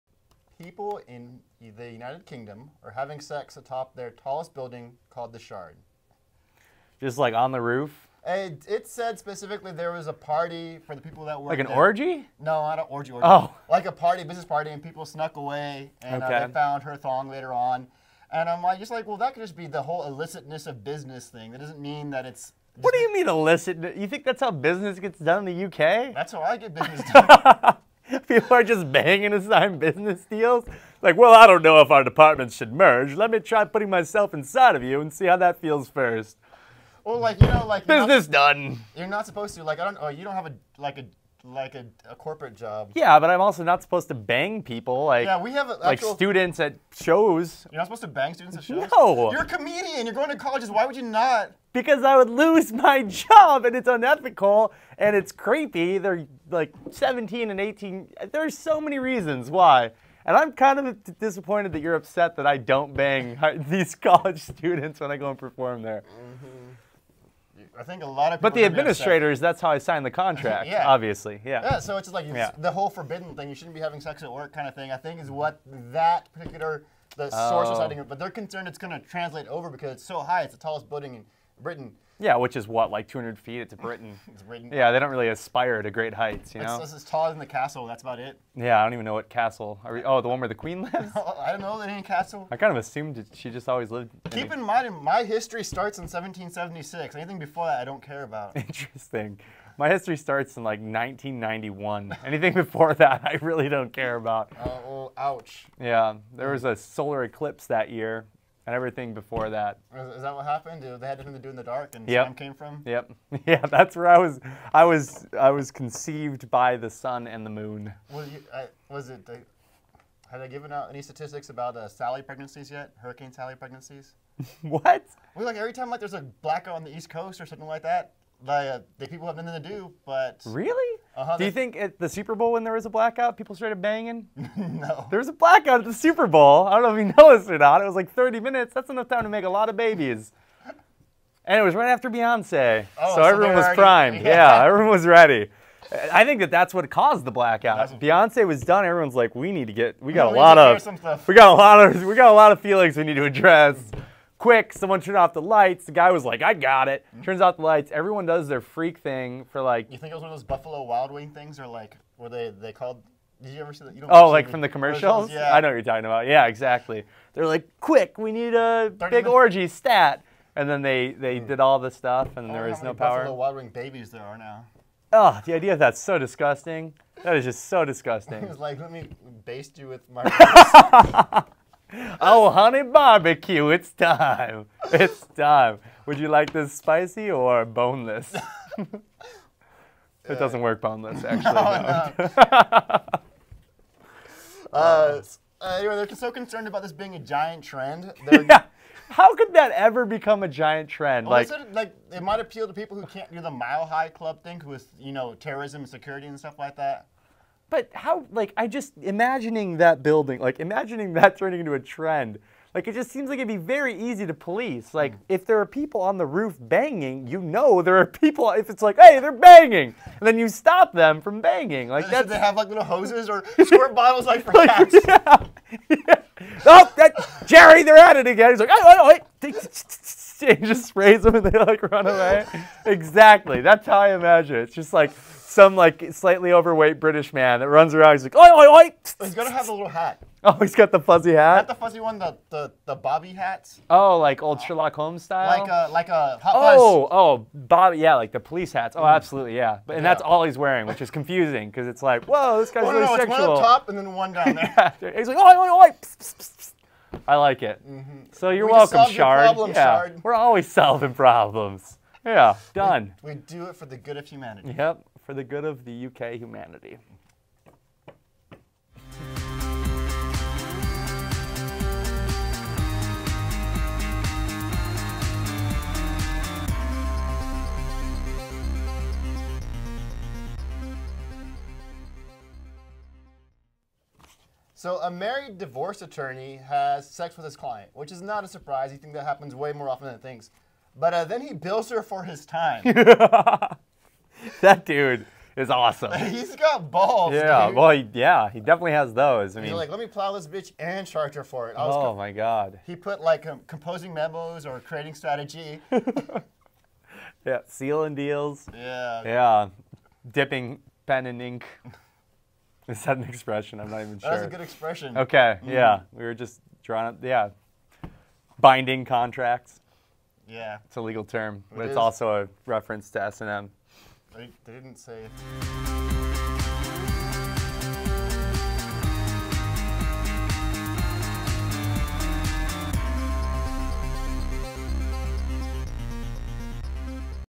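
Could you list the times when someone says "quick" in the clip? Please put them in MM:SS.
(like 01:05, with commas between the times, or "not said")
02:34, 02:47.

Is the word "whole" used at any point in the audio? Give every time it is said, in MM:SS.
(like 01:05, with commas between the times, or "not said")
00:19, 01:12.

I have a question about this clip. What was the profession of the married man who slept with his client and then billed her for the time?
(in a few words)
Divorce attorney.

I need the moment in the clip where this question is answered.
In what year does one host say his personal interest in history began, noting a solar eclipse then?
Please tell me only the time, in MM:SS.
01:40.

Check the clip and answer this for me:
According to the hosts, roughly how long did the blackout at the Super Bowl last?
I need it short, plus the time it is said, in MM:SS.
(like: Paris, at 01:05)
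30 minutes, at 02:18.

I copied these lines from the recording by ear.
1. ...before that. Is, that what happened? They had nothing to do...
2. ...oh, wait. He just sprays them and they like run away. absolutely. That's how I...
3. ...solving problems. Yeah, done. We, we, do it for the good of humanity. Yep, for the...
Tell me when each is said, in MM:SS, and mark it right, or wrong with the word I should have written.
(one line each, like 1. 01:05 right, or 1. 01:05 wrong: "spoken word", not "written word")
1. 01:49 right
2. 03:48 wrong: "exactly", not "absolutely"
3. 04:20 right.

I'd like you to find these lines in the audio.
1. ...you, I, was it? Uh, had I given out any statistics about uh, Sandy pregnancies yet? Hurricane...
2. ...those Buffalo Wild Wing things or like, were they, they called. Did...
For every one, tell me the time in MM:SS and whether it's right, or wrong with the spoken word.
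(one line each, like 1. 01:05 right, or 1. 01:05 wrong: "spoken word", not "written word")
1. 01:58 right
2. 02:40 right.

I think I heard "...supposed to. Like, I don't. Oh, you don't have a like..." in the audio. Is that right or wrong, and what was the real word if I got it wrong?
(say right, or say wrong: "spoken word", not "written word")
right.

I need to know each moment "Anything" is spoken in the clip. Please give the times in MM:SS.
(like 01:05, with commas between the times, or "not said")
01:37, 01:42.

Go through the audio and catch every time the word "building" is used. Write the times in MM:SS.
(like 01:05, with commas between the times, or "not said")
00:04, 01:20, 03:30.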